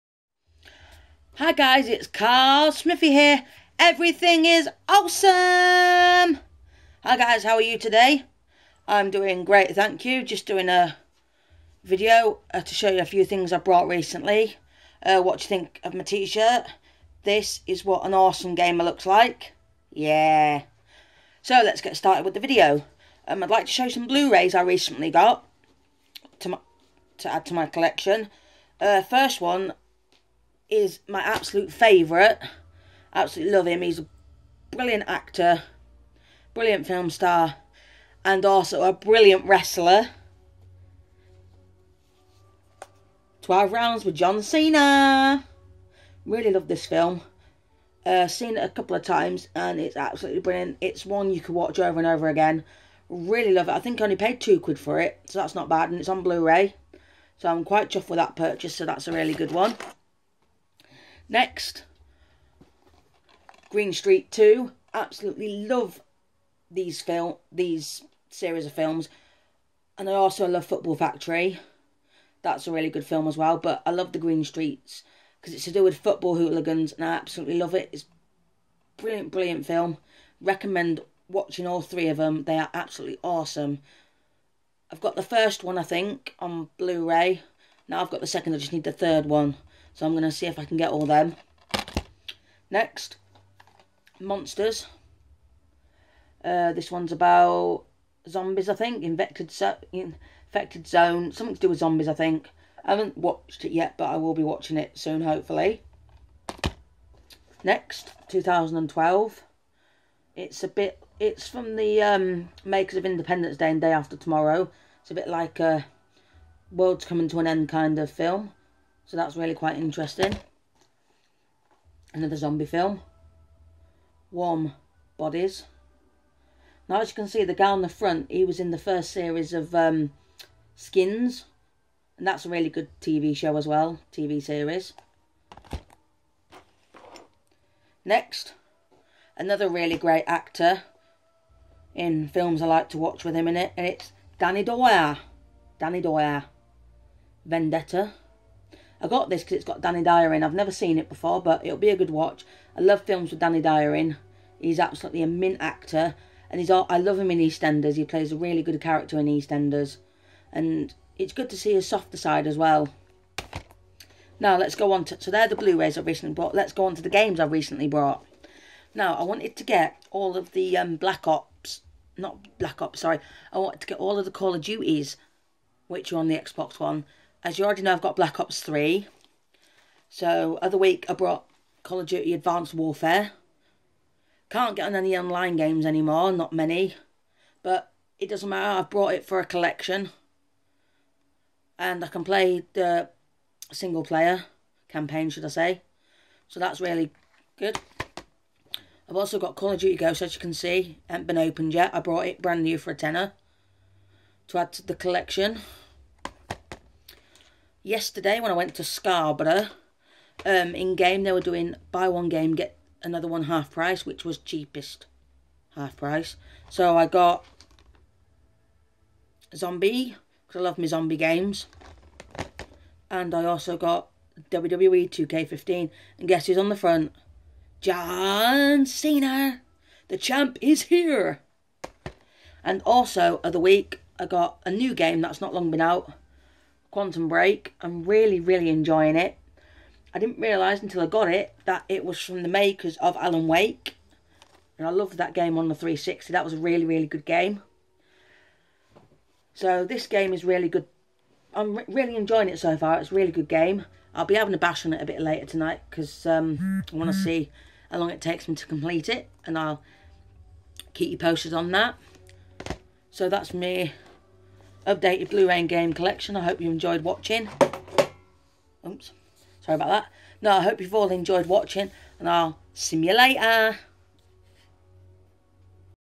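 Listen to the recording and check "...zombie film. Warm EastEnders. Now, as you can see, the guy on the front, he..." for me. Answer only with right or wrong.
wrong.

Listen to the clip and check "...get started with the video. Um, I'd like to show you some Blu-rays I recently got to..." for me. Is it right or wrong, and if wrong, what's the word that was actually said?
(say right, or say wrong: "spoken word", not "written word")
right.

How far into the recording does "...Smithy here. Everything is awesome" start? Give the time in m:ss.
0:02.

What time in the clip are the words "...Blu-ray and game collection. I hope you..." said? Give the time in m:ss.
4:25.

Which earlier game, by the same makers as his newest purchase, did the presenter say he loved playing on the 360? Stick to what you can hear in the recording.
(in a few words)
Alan Wake.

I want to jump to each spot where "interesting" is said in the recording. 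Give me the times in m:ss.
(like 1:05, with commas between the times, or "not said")
1:59.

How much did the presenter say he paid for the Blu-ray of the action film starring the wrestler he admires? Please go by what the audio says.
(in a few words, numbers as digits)
2 quid.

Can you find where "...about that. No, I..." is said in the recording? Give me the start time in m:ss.
4:29.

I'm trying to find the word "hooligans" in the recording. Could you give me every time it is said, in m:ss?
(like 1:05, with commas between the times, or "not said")
1:16.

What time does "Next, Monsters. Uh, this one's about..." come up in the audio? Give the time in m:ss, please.
1:32.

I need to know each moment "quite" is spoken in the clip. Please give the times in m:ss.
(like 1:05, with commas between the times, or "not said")
0:57, 1:59.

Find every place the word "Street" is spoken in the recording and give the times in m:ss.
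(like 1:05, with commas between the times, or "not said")
1:03, 1:14.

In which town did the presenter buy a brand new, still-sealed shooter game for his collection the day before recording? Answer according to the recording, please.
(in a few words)
Scarborough.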